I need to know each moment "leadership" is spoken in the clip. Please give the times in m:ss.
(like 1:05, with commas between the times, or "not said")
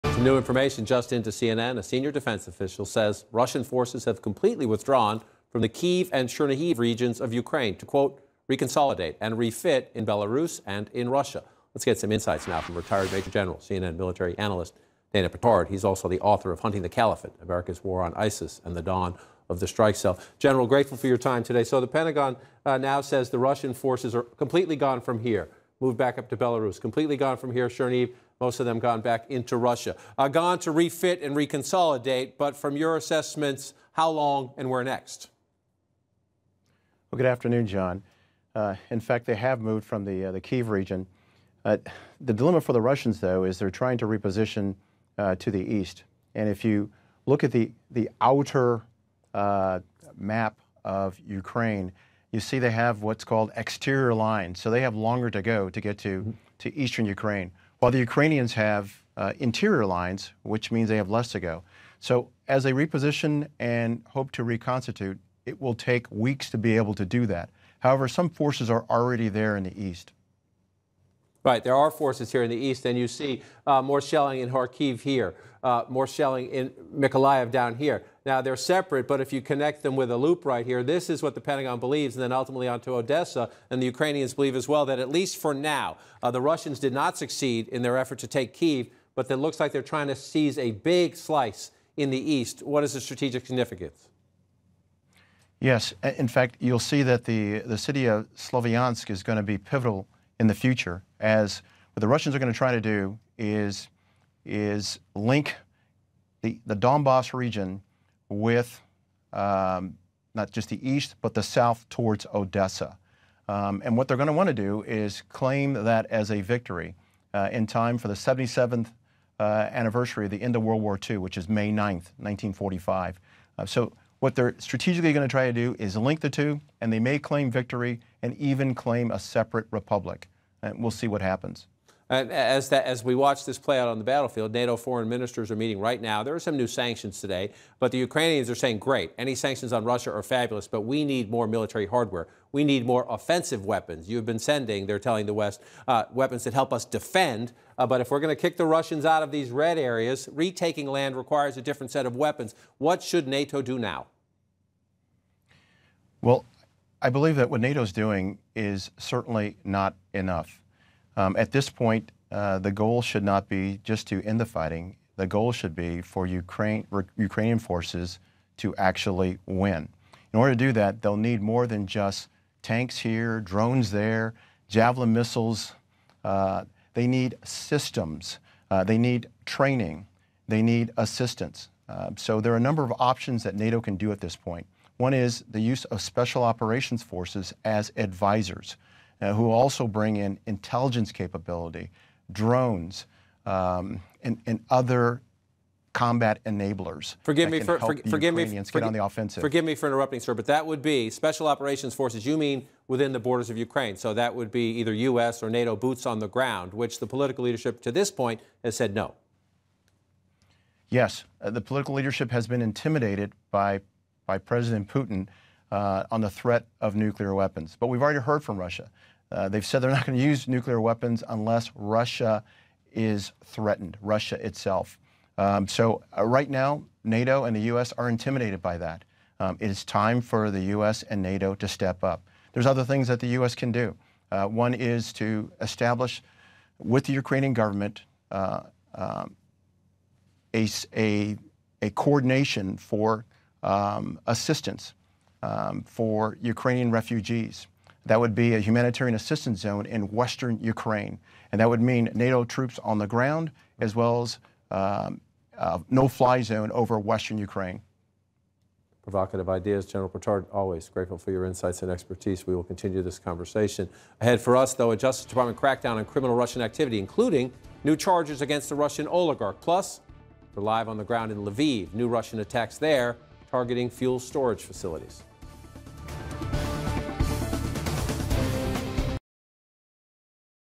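3:27, 3:31.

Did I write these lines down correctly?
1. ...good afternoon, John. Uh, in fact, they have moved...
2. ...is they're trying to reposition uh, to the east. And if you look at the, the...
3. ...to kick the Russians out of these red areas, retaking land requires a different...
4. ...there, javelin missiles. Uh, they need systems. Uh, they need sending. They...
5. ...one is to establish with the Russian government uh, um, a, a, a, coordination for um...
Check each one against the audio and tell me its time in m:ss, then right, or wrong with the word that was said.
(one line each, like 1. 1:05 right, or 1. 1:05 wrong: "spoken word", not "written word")
1. 0:37 right
2. 0:43 right
3. 2:28 right
4. 2:53 wrong: "training", not "sending"
5. 3:54 wrong: "Ukrainian", not "Russian".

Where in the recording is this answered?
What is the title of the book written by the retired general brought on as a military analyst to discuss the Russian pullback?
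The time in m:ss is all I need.
0:16.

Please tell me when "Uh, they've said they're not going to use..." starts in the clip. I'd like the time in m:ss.
3:39.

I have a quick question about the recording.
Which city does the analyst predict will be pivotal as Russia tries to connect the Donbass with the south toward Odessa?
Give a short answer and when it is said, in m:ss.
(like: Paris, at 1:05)
Sloviansk, at 1:38.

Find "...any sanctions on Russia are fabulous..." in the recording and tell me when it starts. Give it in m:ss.
2:19.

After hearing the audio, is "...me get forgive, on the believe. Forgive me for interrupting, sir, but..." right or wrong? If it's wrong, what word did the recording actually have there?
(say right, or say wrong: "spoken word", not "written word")
wrong: "offensive", not "believe".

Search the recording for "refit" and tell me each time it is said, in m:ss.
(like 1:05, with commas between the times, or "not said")
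0:09, 0:30.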